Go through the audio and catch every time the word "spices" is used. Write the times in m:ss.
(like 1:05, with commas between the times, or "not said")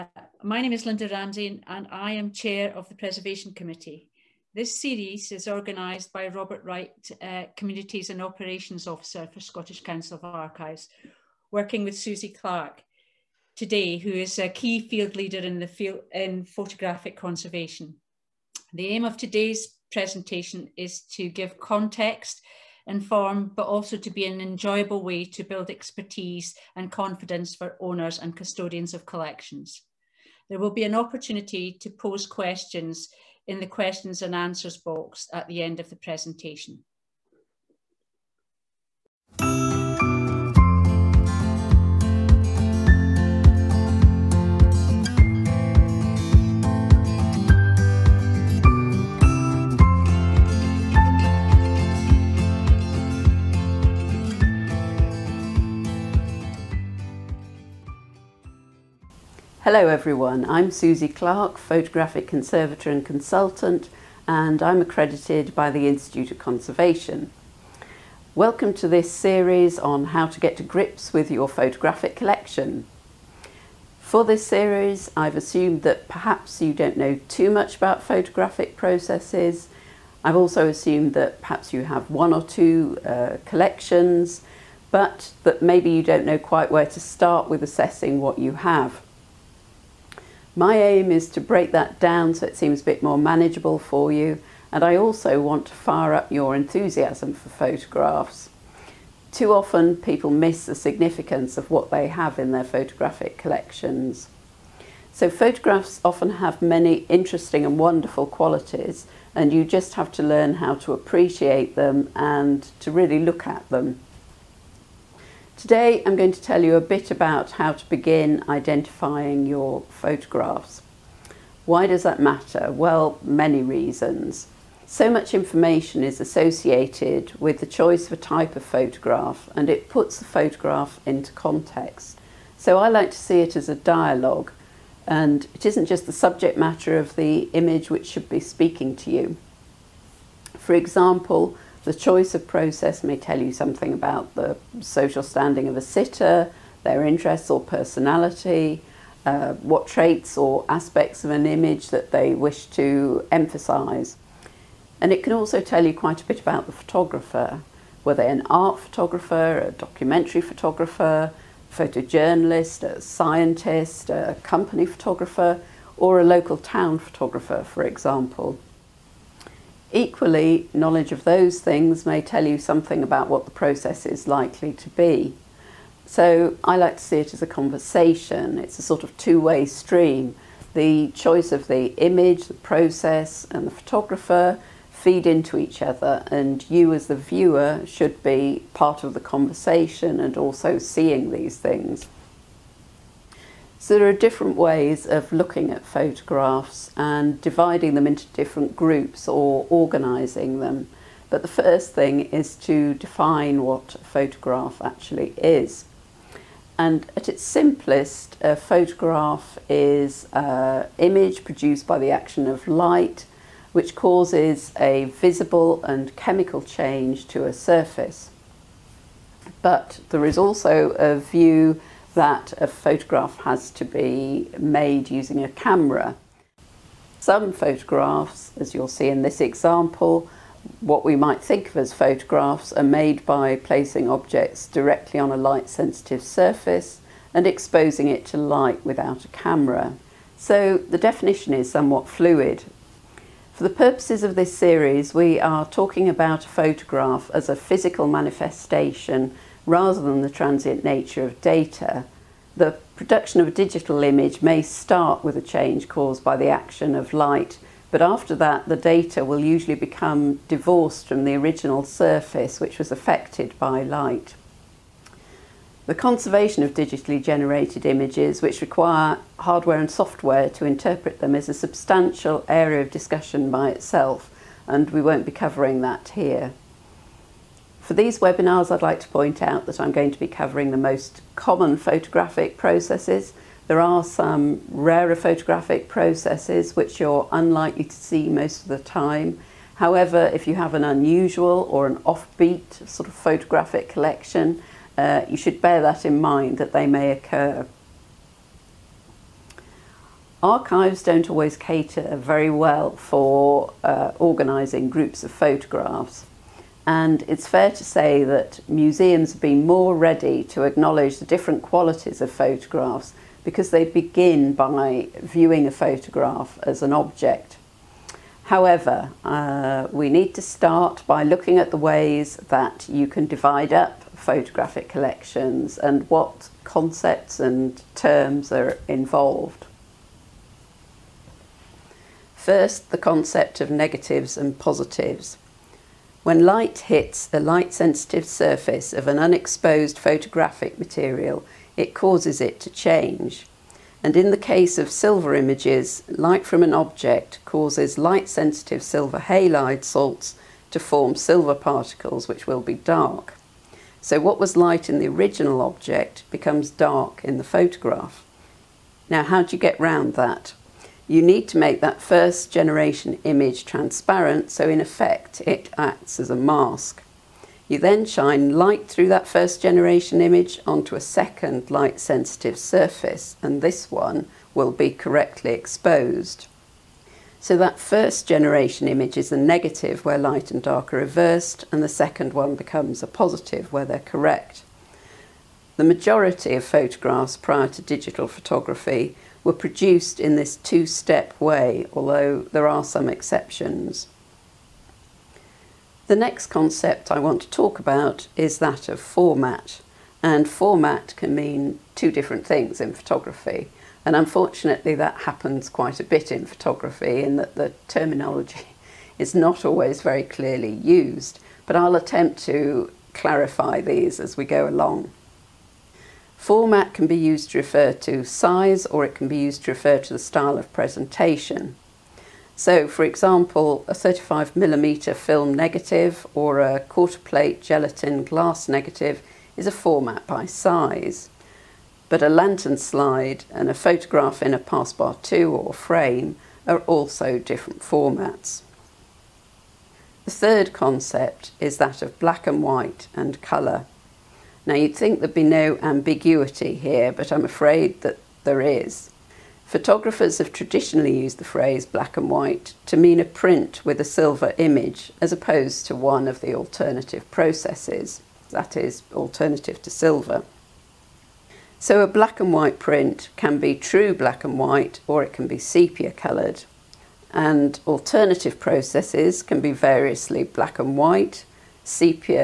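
not said.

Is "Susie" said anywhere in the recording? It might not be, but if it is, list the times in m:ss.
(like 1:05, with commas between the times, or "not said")
0:11, 1:00.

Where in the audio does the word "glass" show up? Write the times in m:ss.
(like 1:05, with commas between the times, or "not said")
7:08.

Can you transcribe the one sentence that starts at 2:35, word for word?
And it can also tell you quite a bit about the photographer.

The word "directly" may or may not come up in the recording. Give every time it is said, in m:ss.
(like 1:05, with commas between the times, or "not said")
3:54.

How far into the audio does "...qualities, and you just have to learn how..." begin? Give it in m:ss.
1:48.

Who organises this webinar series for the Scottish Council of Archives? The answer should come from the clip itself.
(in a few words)
Robert Wright.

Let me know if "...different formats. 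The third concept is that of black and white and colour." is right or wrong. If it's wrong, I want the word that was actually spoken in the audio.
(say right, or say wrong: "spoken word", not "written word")
right.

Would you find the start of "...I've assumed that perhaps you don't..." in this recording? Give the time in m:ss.
1:15.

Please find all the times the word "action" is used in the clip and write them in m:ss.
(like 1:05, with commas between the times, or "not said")
3:32, 4:16.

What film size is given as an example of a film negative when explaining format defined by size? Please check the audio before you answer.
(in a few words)
35 millimeter.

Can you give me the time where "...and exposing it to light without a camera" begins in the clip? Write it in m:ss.
3:57.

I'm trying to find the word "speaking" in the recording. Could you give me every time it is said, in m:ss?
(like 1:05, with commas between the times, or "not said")
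2:18.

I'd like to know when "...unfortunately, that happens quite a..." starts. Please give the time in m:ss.
6:44.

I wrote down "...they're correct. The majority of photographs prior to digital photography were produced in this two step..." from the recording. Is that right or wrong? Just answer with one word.
right.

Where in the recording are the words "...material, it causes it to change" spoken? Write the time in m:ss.
5:40.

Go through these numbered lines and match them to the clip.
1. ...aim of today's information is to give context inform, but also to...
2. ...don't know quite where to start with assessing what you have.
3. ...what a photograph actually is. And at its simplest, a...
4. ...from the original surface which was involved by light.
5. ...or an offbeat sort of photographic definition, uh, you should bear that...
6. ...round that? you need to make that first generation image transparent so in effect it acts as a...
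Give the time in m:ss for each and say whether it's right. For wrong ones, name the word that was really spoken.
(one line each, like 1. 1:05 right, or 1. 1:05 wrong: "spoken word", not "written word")
1. 0:18 wrong: "presentation", not "information"
2. 1:26 right
3. 3:23 right
4. 4:21 wrong: "affected", not "involved"
5. 4:51 wrong: "collection", not "definition"
6. 5:59 right.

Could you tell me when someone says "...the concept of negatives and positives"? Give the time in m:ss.
5:32.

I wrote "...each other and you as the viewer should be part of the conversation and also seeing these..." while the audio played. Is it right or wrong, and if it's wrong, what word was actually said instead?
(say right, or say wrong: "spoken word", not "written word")
right.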